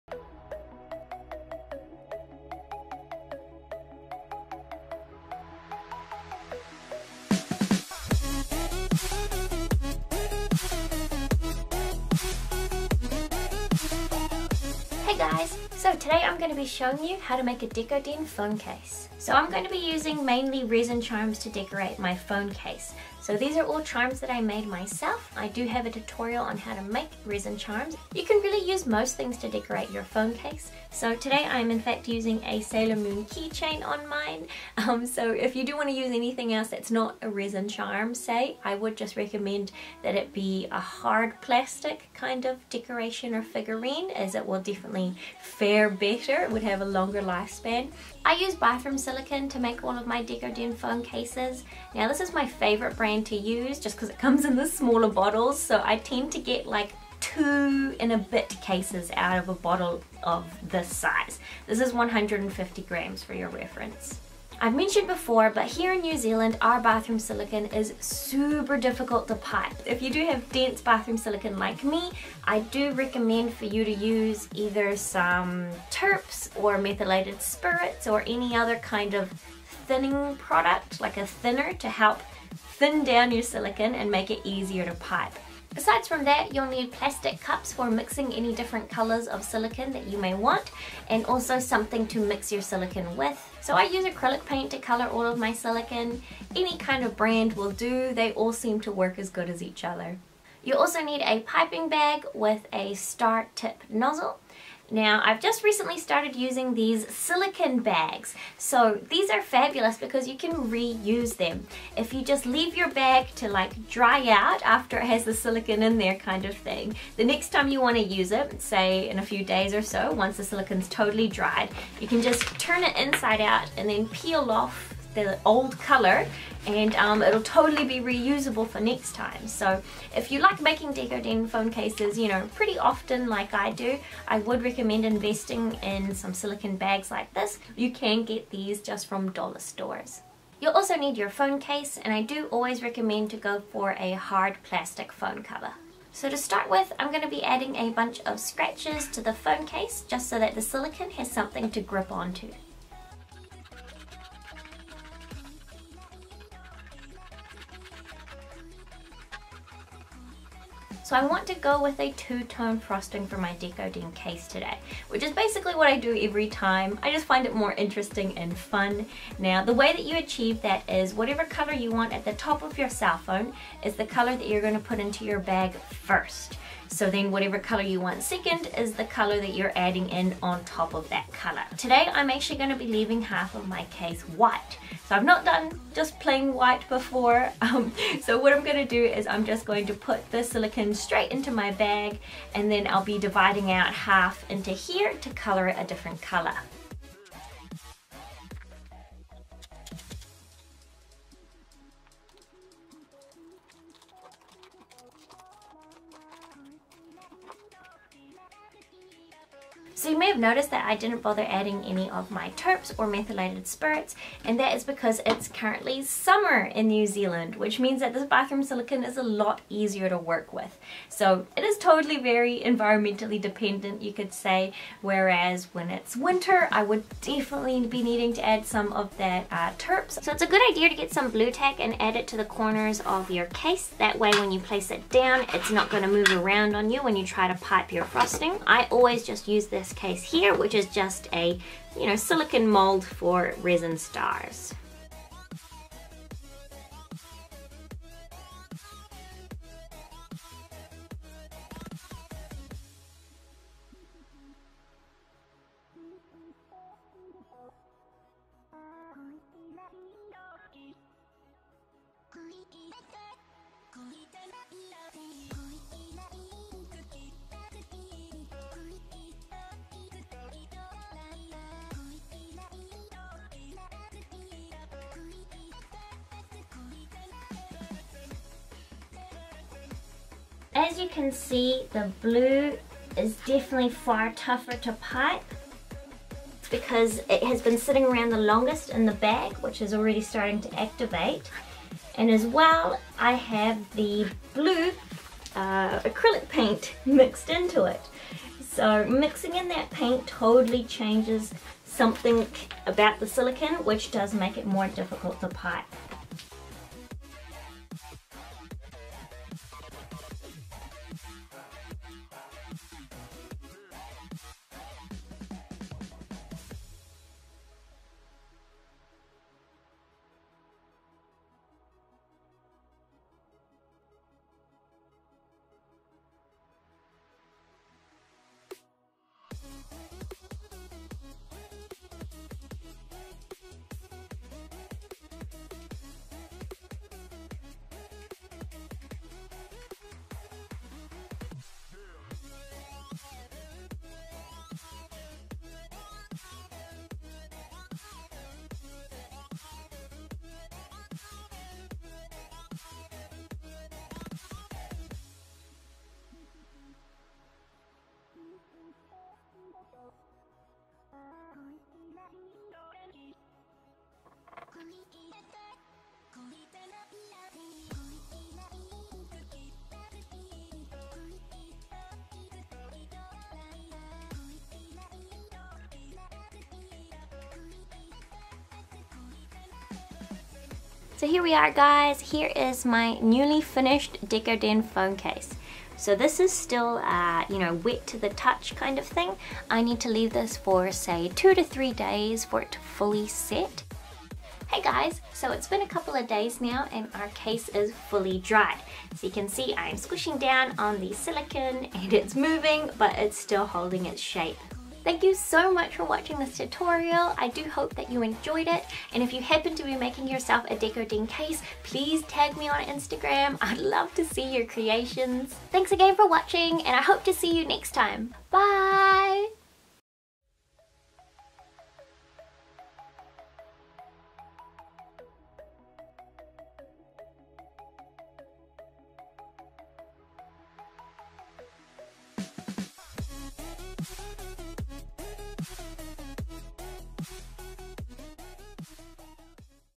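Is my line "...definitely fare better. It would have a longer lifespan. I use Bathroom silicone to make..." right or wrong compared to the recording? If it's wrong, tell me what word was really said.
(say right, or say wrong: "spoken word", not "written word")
right.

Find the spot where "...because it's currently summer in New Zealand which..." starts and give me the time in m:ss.
3:34.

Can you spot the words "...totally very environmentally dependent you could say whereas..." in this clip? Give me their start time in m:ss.
3:41.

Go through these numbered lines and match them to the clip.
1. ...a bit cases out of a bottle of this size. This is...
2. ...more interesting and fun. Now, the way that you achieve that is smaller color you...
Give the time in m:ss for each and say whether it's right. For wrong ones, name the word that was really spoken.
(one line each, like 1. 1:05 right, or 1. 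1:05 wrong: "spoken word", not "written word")
1. 0:58 right
2. 2:47 wrong: "whatever", not "smaller".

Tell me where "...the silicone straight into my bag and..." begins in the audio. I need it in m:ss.
3:10.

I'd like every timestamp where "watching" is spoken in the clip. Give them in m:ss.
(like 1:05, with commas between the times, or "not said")
6:46, 6:56.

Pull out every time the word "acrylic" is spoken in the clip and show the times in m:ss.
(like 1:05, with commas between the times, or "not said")
1:34, 4:55.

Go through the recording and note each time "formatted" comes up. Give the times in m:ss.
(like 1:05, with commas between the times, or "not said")
not said.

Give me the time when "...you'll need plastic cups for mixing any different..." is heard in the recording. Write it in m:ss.
1:26.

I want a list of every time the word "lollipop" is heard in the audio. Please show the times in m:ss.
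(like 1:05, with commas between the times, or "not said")
not said.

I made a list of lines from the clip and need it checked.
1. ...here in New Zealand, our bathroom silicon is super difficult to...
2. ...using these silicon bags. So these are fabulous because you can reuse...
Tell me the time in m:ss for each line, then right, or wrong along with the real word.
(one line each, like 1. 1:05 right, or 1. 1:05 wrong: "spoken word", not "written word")
1. 1:05 right
2. 1:46 right.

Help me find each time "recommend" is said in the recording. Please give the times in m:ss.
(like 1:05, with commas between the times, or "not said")
0:39, 1:12, 2:14, 2:22.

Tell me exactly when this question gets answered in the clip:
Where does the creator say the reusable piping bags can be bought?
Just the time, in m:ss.
2:19.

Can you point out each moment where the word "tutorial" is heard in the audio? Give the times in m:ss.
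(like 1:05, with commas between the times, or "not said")
0:25, 6:46.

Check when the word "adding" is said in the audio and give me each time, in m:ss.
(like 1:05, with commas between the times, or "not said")
2:27, 2:59, 3:31.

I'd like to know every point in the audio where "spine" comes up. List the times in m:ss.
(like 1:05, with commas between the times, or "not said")
not said.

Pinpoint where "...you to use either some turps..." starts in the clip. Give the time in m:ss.
1:13.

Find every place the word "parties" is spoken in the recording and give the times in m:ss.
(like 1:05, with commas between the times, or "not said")
not said.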